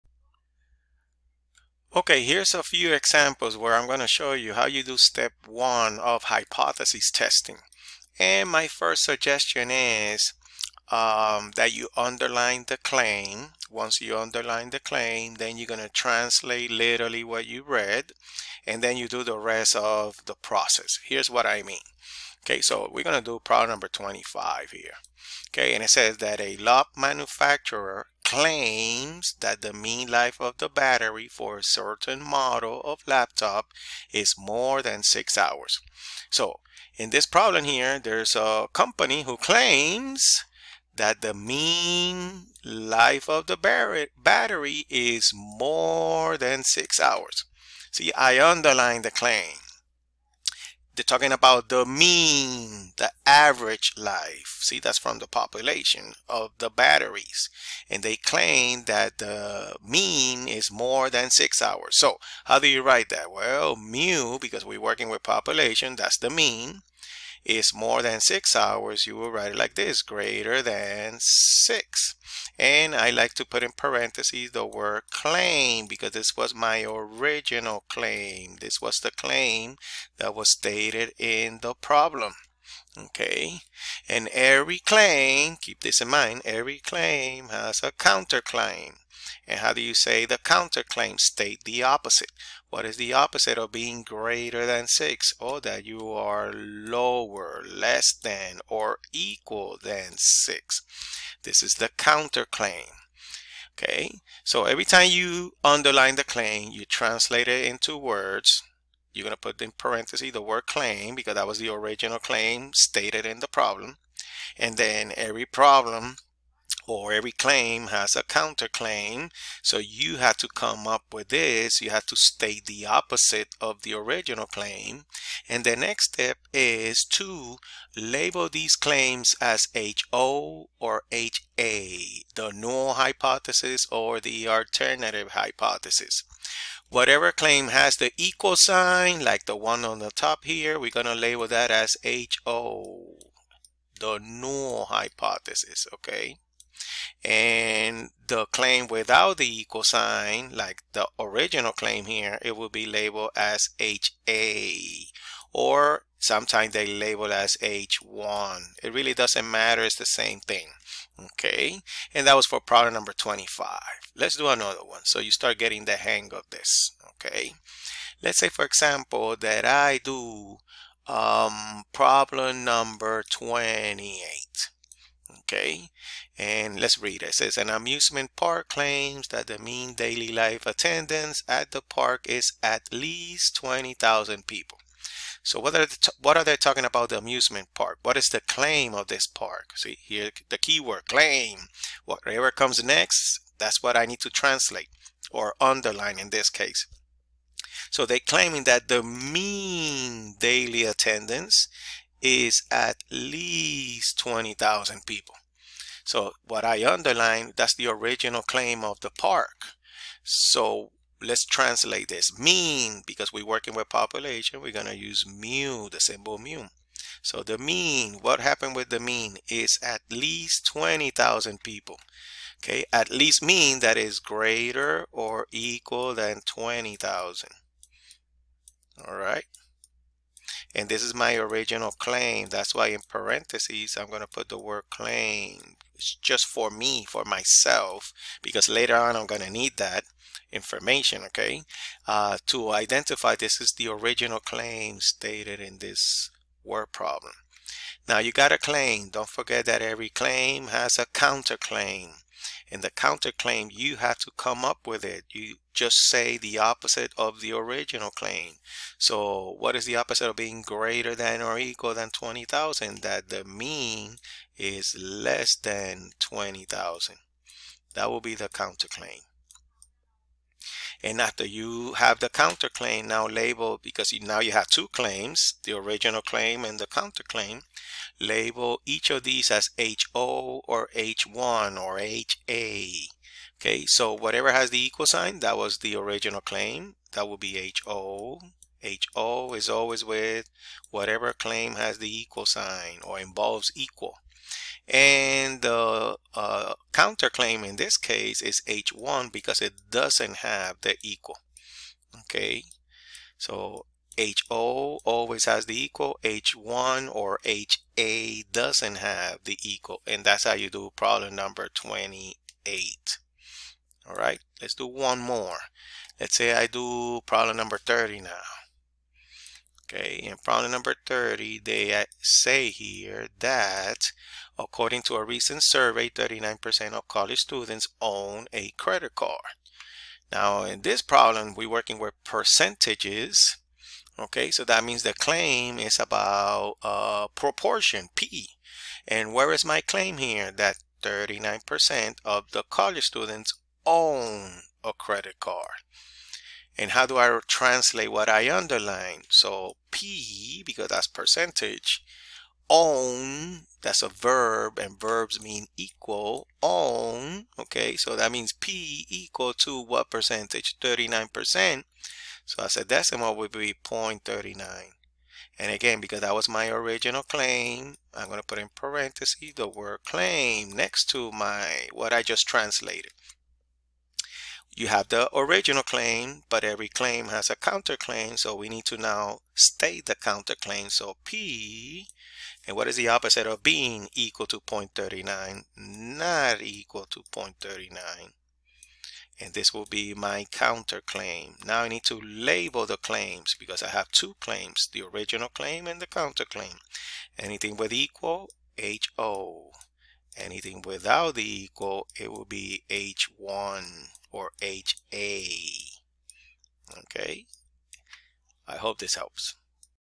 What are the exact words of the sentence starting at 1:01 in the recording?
So how do you write that?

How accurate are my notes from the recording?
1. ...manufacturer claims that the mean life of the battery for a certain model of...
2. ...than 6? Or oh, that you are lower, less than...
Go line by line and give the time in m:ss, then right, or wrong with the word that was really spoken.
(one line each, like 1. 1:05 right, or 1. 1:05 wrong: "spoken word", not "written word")
1. 0:26 right
2. 1:34 right.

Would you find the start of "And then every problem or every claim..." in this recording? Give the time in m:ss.
1:54.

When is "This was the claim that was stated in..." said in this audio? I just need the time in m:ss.
1:18.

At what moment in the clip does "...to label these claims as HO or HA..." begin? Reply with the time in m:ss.
2:07.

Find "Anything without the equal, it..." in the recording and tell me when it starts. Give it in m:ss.
6:40.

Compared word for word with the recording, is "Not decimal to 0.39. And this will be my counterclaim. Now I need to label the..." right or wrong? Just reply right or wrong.
wrong.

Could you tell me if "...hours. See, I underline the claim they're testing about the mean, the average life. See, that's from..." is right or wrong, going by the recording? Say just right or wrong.
wrong.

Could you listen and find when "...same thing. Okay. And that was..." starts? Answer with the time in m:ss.
2:40.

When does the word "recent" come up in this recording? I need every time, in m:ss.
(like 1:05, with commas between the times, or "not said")
5:25.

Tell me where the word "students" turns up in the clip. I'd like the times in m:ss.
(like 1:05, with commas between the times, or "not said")
5:27, 5:43.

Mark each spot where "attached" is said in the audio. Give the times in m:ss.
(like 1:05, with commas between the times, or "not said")
not said.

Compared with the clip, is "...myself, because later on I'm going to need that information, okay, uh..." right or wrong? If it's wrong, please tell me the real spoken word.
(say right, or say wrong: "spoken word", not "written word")
right.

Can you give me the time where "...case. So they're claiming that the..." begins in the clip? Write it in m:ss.
3:16.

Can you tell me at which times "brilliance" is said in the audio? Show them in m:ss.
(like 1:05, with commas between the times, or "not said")
not said.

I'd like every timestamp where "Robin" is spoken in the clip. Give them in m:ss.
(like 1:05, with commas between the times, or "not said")
not said.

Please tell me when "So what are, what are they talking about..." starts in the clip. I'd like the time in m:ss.
3:05.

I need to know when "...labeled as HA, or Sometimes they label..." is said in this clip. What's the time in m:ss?
2:32.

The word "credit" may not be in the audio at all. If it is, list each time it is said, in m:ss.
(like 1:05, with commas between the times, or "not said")
5:28, 5:44.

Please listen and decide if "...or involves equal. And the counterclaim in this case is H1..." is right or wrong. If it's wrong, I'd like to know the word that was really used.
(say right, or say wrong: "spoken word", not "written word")
right.